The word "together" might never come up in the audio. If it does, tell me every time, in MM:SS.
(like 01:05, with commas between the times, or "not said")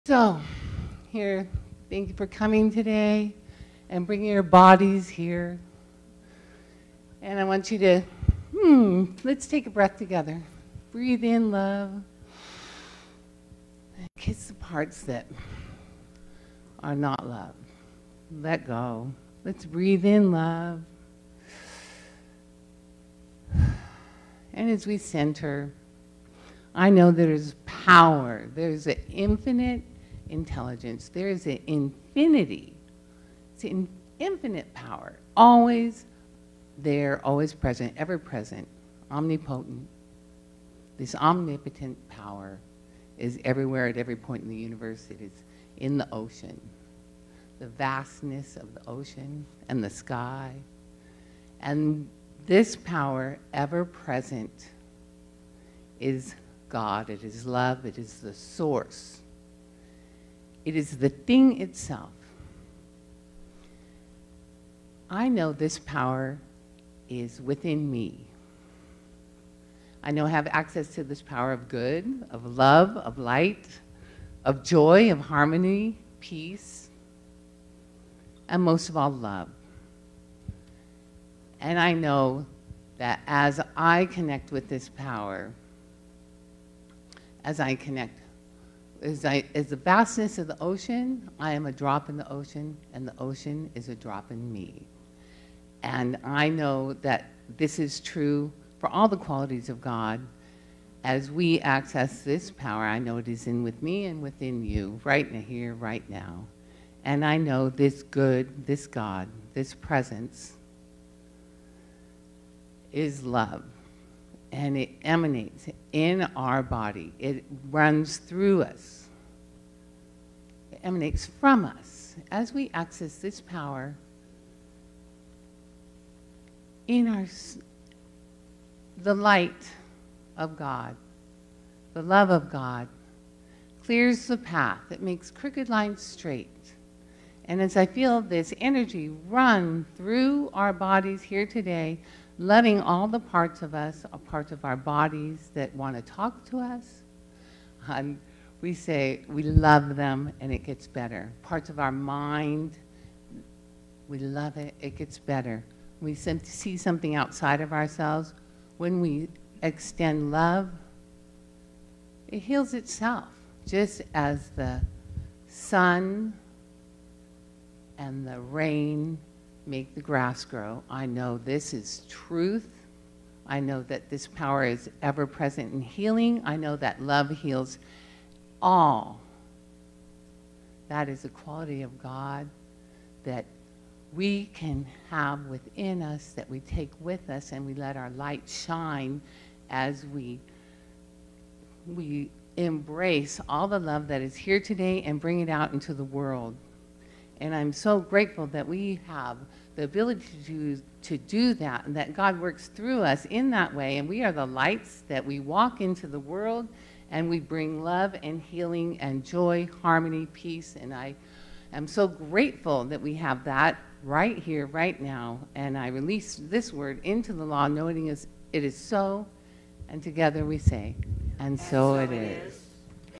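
00:09, 03:40.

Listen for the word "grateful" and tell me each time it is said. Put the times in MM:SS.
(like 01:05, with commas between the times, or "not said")
03:17, 03:32.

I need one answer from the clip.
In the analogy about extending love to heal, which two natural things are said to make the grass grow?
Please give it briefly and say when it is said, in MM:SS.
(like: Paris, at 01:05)
The sun and the rain, at 02:44.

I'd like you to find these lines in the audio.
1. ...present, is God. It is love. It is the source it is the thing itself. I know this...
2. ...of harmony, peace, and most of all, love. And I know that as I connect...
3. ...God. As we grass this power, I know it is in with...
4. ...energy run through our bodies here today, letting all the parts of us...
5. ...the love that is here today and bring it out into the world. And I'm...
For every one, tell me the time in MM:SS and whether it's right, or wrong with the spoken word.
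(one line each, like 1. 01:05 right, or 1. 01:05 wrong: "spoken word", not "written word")
1. 00:53 right
2. 01:15 right
3. 01:39 wrong: "access", not "grass"
4. 02:18 right
5. 03:13 right.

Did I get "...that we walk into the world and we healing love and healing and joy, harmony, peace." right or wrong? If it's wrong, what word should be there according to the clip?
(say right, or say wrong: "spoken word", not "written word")
wrong: "bring", not "healing".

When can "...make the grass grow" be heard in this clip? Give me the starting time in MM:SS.
02:49.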